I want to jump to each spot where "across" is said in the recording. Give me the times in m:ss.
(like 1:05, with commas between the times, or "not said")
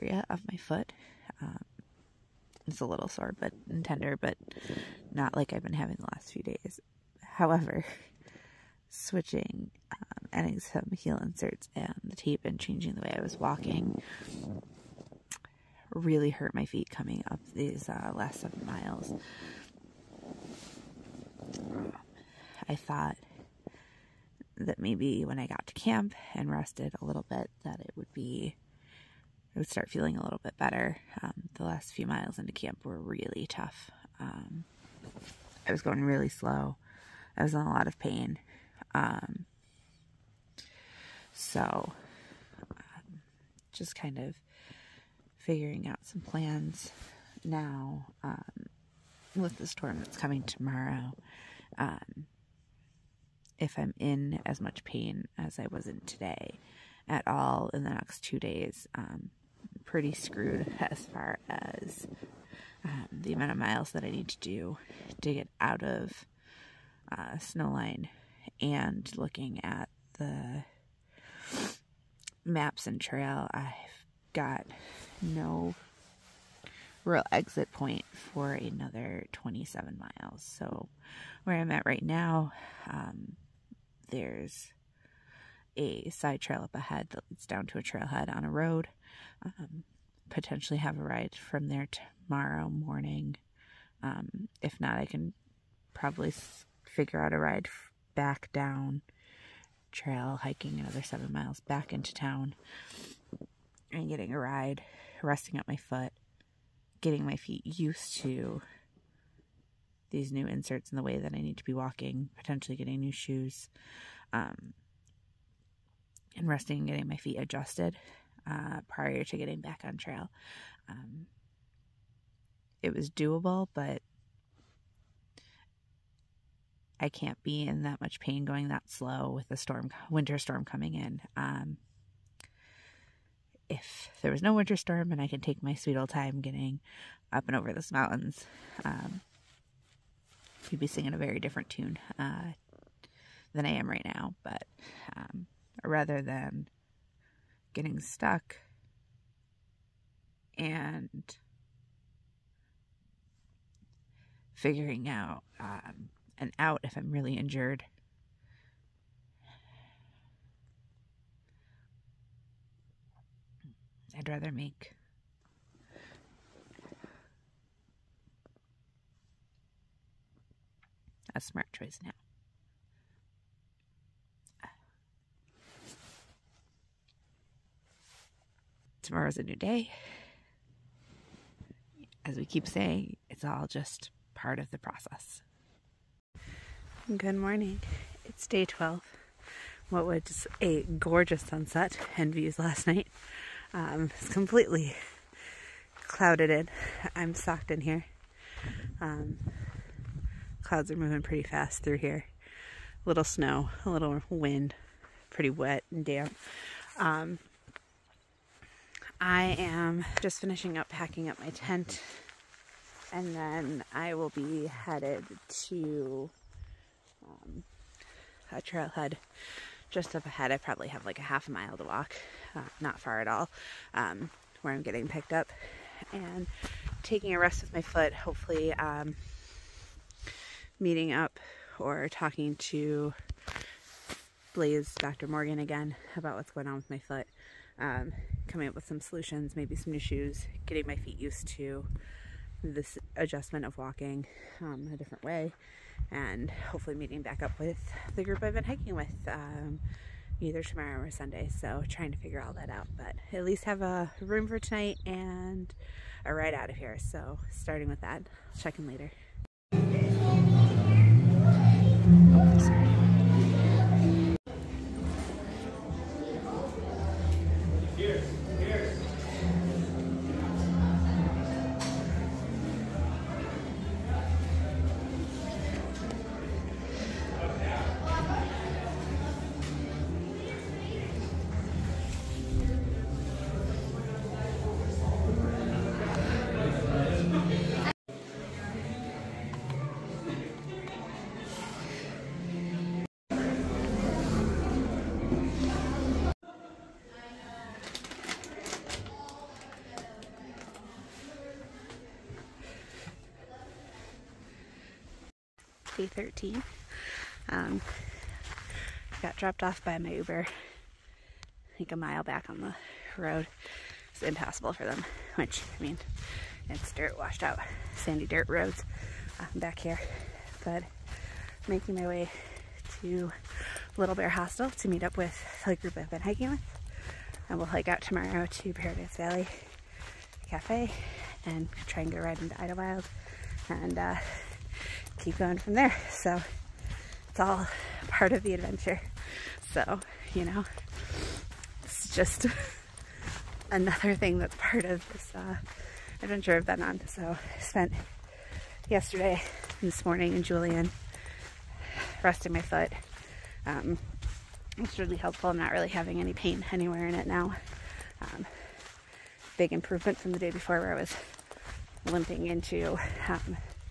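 not said.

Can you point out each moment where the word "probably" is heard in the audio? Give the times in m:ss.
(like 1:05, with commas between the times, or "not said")
1:35, 3:40.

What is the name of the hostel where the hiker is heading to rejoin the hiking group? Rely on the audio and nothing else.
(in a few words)
Little Bear Hostel.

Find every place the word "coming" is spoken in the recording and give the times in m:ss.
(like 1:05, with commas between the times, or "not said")
0:16, 0:50, 2:10, 3:58.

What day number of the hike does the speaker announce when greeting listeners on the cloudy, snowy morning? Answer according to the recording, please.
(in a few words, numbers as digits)
Day 12.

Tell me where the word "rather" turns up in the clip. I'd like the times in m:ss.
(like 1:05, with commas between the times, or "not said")
2:25, 2:44.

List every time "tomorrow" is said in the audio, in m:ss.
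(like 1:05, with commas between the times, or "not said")
0:50, 1:32, 2:59, 4:10, 5:28.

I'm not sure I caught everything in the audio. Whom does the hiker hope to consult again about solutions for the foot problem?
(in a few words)
Blaze Dr. Morgan.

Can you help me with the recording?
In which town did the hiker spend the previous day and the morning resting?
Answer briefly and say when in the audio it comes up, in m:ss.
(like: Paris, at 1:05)
Julian, at 5:50.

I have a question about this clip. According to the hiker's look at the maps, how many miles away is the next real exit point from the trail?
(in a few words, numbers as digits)
27 miles.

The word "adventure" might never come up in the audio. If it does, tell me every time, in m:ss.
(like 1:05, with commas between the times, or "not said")
5:38, 5:46.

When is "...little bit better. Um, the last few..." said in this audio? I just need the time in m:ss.
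0:30.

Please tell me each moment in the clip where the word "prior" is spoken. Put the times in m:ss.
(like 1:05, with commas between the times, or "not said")
1:58.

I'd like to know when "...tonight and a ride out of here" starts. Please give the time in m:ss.
4:14.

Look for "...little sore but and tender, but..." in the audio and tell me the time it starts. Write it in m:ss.
0:02.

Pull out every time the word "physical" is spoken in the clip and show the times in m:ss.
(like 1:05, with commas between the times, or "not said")
not said.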